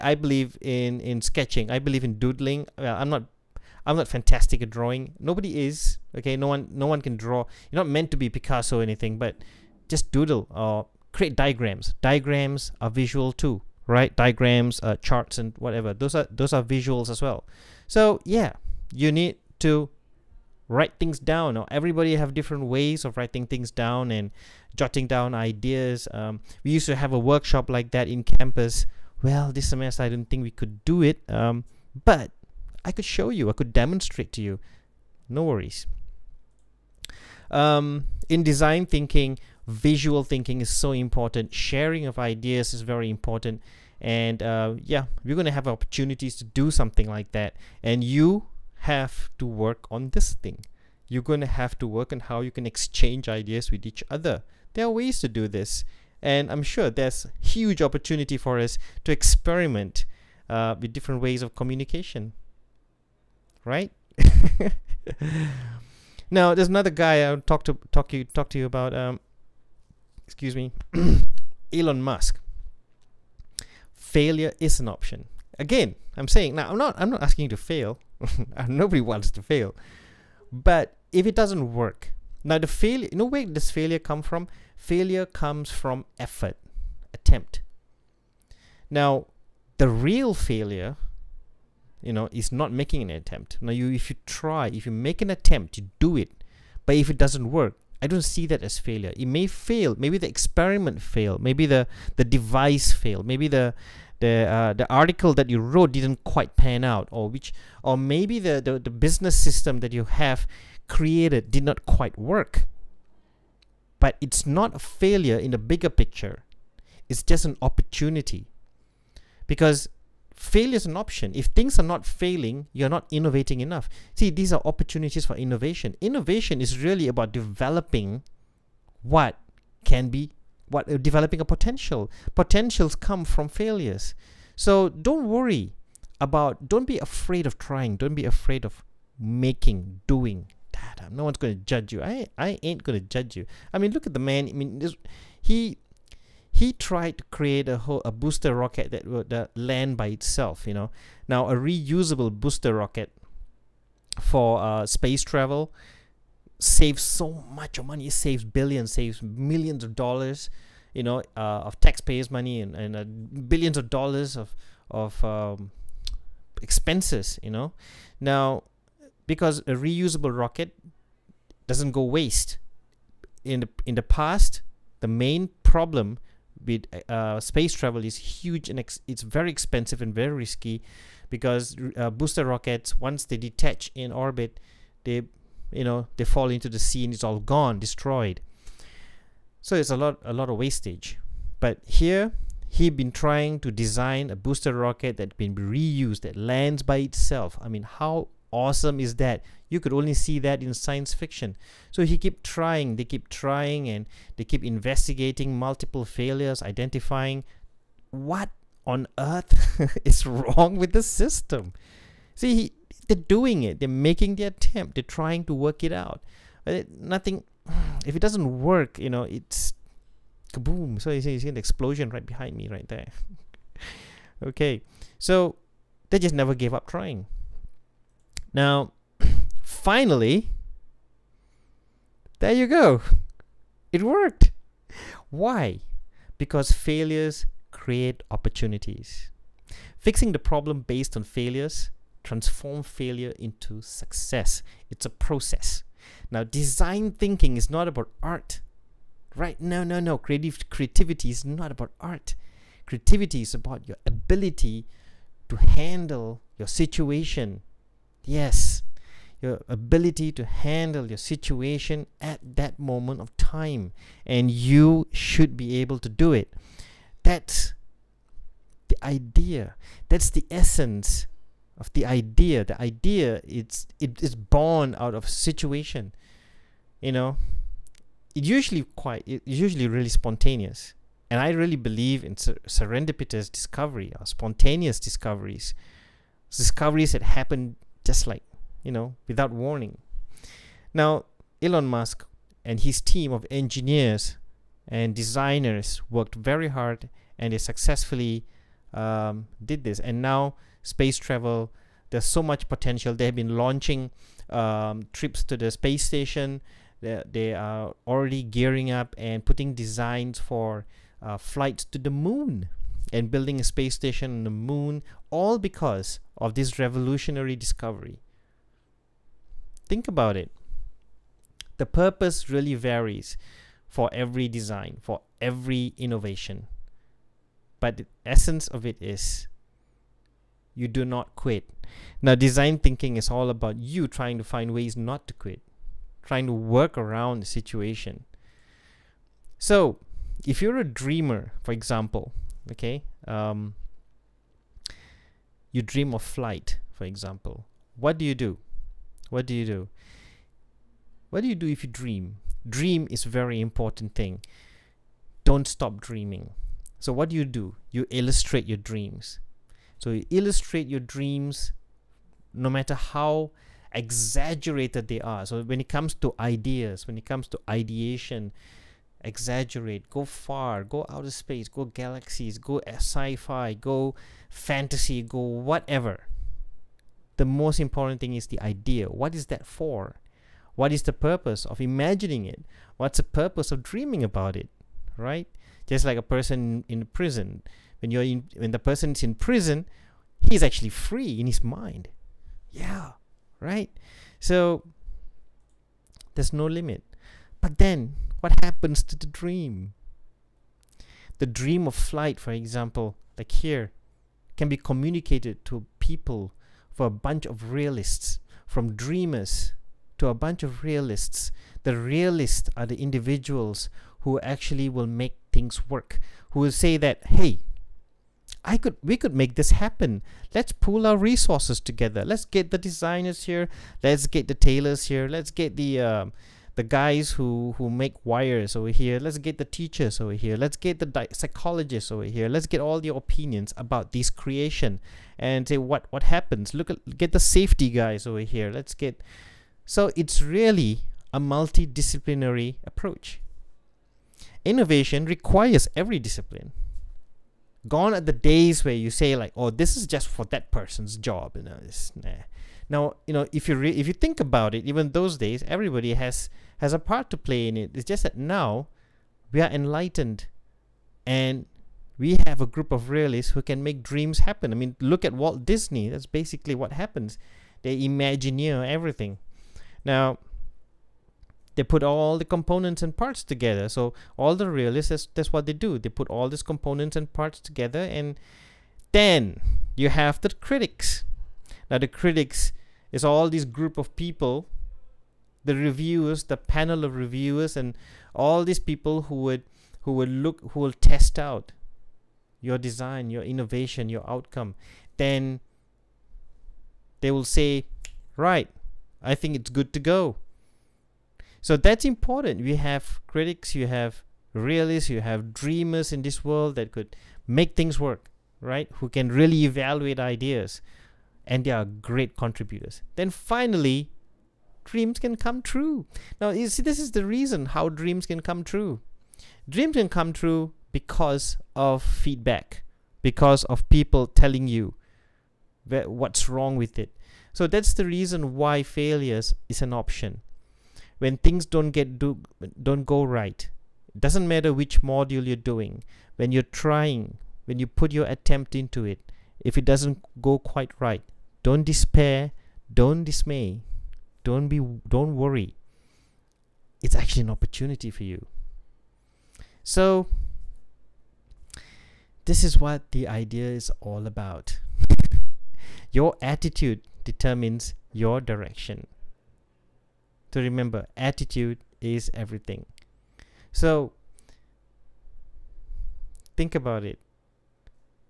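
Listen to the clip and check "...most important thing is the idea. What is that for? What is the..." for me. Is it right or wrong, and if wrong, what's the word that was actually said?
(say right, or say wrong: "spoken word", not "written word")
right.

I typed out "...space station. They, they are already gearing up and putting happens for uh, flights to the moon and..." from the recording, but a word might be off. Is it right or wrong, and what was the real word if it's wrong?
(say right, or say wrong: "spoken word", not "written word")
wrong: "designs", not "happens".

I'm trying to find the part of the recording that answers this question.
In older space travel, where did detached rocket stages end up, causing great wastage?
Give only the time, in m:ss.
3:06.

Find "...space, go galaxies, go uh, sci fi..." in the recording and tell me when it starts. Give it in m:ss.
6:11.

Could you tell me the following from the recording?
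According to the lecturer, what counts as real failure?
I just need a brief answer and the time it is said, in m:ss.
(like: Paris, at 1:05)
not making an attempt, at 1:32.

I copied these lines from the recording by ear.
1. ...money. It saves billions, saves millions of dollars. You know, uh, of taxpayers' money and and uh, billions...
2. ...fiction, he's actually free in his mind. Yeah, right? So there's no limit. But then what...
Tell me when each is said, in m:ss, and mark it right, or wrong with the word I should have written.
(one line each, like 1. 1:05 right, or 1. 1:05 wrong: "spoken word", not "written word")
1. 2:37 right
2. 6:29 wrong: "prison", not "fiction".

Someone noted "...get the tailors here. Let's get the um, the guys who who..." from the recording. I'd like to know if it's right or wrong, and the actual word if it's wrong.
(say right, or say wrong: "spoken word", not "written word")
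right.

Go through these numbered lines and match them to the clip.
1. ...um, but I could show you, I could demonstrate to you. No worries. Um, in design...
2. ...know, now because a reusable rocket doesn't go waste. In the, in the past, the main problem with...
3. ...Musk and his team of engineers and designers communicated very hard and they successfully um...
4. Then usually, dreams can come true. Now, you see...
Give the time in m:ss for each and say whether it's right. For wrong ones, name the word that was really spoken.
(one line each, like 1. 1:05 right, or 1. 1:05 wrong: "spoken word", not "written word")
1. 0:31 right
2. 2:47 right
3. 4:51 wrong: "worked", not "communicated"
4. 8:33 wrong: "finally", not "usually".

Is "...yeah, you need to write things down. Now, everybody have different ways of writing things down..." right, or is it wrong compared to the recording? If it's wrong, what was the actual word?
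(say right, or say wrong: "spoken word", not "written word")
right.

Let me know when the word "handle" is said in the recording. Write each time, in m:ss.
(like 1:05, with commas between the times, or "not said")
4:15, 4:20.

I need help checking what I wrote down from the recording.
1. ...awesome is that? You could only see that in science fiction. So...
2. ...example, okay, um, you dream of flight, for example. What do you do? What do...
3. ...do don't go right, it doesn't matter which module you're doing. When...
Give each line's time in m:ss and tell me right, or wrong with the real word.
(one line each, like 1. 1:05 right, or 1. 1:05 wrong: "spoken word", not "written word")
1. 3:18 right
2. 5:41 right
3. 8:52 right.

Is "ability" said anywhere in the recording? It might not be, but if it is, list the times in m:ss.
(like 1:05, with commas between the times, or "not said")
4:14, 4:19.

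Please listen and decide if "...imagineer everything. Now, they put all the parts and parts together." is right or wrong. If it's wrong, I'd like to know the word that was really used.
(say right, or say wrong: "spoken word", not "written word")
wrong: "components", not "parts".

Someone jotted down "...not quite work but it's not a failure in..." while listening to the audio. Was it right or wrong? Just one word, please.
right.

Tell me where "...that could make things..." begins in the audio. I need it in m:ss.
8:26.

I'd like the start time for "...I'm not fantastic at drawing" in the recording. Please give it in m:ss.
0:03.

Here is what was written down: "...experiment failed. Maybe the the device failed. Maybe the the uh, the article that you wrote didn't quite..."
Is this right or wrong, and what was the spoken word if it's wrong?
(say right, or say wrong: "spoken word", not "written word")
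right.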